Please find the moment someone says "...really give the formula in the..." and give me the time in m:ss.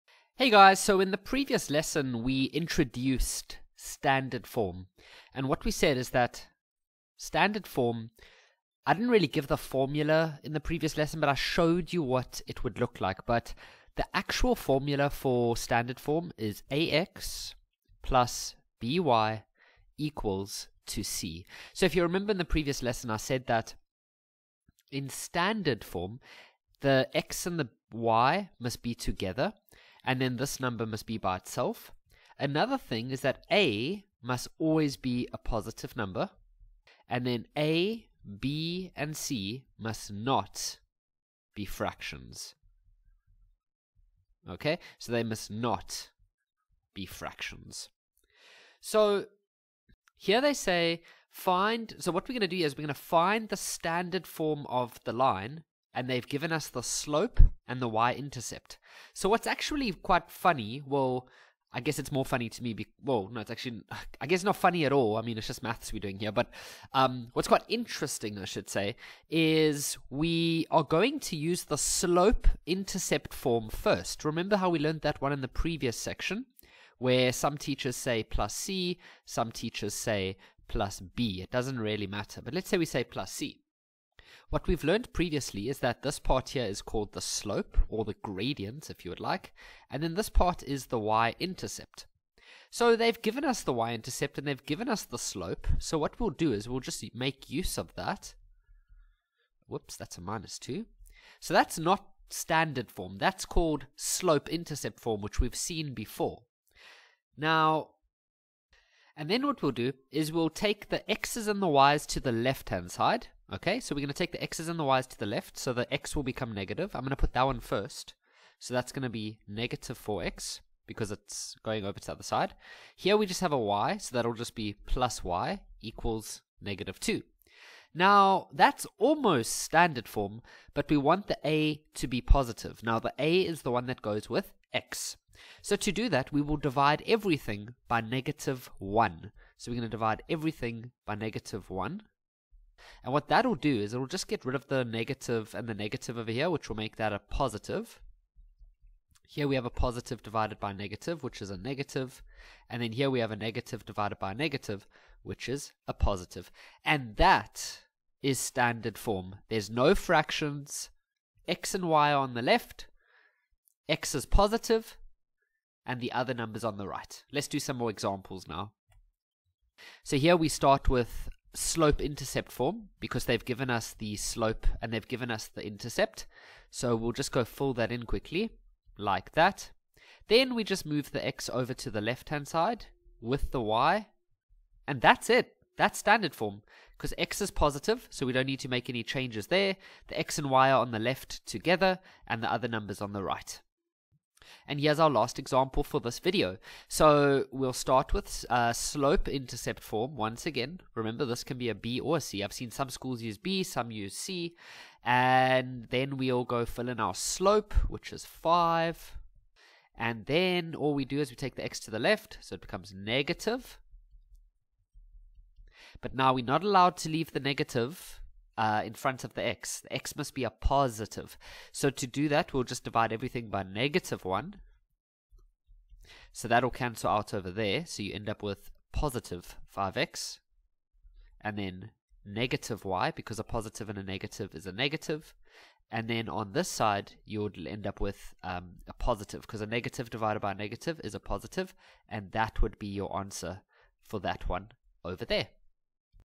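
0:09.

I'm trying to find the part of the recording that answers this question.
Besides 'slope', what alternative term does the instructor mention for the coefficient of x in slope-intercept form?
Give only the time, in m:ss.
1:28.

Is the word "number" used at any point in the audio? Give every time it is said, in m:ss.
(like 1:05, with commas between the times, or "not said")
0:30, 0:35, 2:46, 3:12.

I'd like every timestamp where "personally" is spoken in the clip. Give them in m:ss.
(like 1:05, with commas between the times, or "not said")
not said.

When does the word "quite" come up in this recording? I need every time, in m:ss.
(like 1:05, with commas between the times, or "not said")
0:59, 1:07.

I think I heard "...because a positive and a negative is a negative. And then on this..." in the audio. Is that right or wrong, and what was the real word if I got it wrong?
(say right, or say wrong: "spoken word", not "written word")
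right.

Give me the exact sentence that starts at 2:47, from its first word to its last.
Let's do some more examples now.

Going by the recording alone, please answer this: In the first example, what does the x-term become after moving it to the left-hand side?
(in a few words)
-4x.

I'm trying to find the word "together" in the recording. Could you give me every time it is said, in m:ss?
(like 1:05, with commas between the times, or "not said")
0:28, 3:11.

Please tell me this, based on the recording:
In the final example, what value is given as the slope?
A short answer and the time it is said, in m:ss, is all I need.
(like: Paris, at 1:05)
5, at 3:28.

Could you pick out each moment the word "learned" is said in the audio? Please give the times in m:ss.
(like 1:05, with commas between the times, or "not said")
1:14, 1:24.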